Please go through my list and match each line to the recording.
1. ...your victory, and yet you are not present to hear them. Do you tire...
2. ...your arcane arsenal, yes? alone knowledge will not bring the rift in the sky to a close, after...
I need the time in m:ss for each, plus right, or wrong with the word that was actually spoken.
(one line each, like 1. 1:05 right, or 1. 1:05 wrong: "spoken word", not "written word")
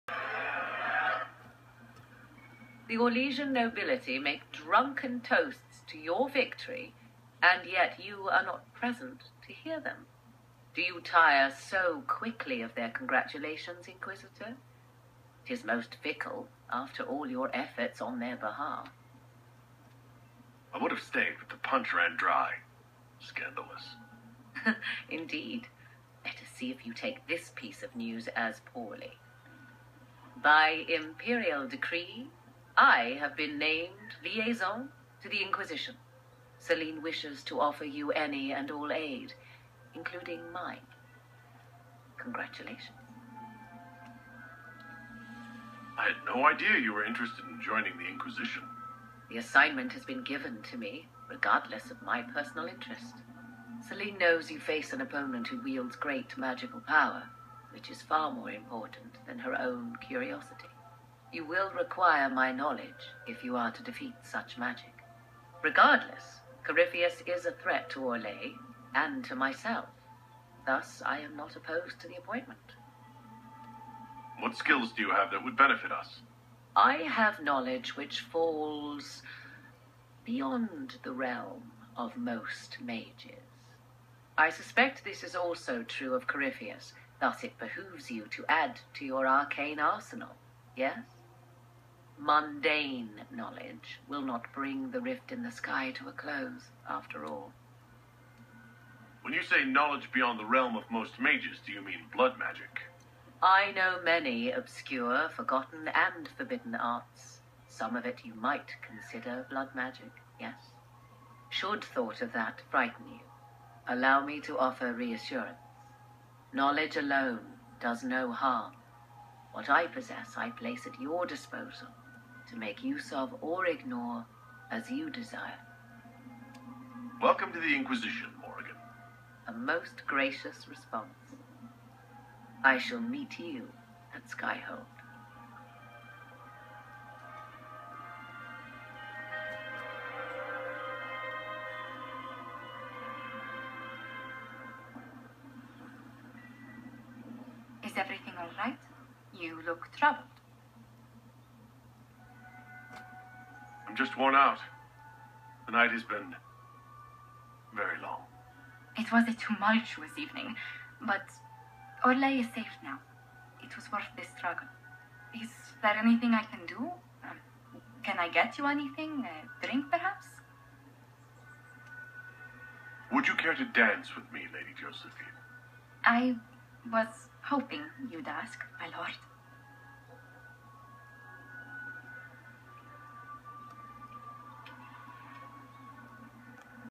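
1. 0:05 right
2. 1:29 wrong: "mundane", not "alone".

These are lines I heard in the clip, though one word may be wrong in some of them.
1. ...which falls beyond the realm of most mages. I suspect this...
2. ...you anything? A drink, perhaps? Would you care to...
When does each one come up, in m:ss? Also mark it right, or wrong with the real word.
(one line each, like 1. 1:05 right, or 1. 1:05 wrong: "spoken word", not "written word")
1. 1:17 right
2. 2:48 right.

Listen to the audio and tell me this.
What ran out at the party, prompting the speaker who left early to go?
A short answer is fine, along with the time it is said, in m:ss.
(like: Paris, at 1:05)
The punch, at 0:21.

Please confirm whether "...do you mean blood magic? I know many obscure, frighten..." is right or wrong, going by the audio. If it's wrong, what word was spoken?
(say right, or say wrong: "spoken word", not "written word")
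wrong: "forgotten", not "frighten".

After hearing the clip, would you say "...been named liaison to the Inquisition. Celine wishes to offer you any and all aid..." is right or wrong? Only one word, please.
right.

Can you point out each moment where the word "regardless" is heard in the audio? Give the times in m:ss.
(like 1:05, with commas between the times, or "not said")
0:51, 1:05.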